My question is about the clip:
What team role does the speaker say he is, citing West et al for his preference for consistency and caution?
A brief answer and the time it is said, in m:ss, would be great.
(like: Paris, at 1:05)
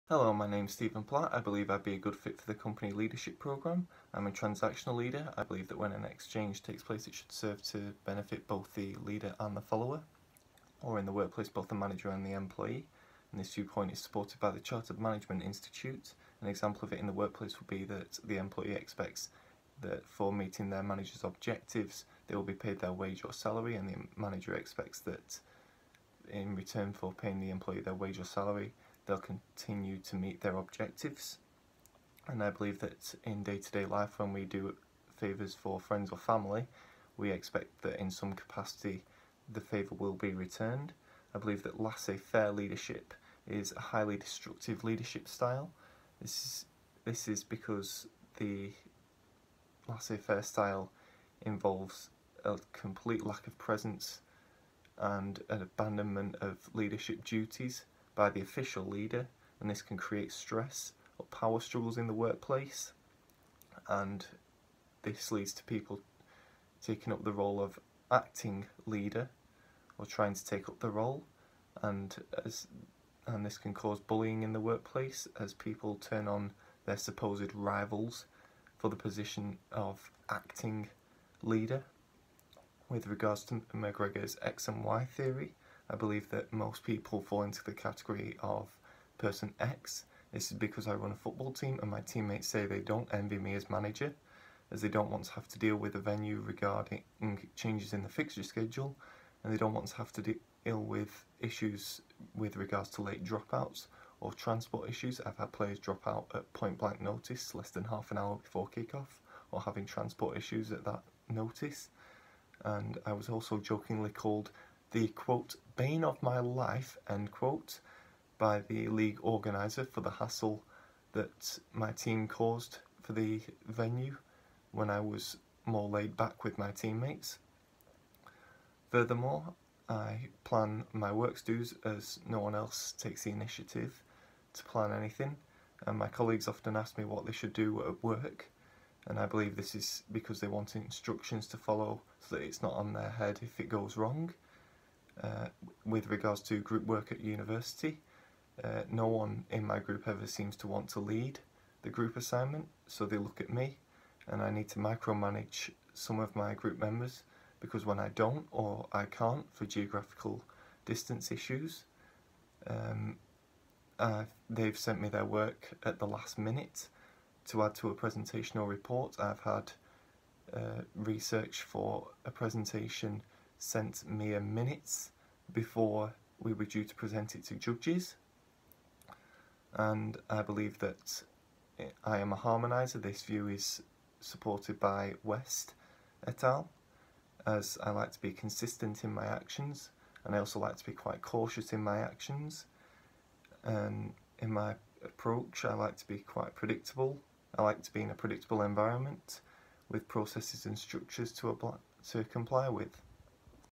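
Harmonizer, at 3:02.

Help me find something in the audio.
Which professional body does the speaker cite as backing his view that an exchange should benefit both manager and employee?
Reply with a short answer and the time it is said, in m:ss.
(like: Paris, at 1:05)
Chartered Management Institute, at 0:14.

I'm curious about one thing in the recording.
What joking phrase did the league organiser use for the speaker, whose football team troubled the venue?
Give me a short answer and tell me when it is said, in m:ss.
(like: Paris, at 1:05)
Bane of my life, at 1:55.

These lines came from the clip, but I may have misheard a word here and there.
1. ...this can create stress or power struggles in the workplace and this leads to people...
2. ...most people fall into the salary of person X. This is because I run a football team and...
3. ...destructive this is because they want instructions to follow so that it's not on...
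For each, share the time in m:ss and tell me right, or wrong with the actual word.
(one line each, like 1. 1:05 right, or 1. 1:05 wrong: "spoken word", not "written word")
1. 0:59 right
2. 1:26 wrong: "category", not "salary"
3. 2:19 wrong: "believe", not "destructive".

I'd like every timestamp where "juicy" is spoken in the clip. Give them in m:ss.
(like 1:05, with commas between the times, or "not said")
not said.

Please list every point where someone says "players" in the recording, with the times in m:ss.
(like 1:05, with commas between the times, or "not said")
1:45.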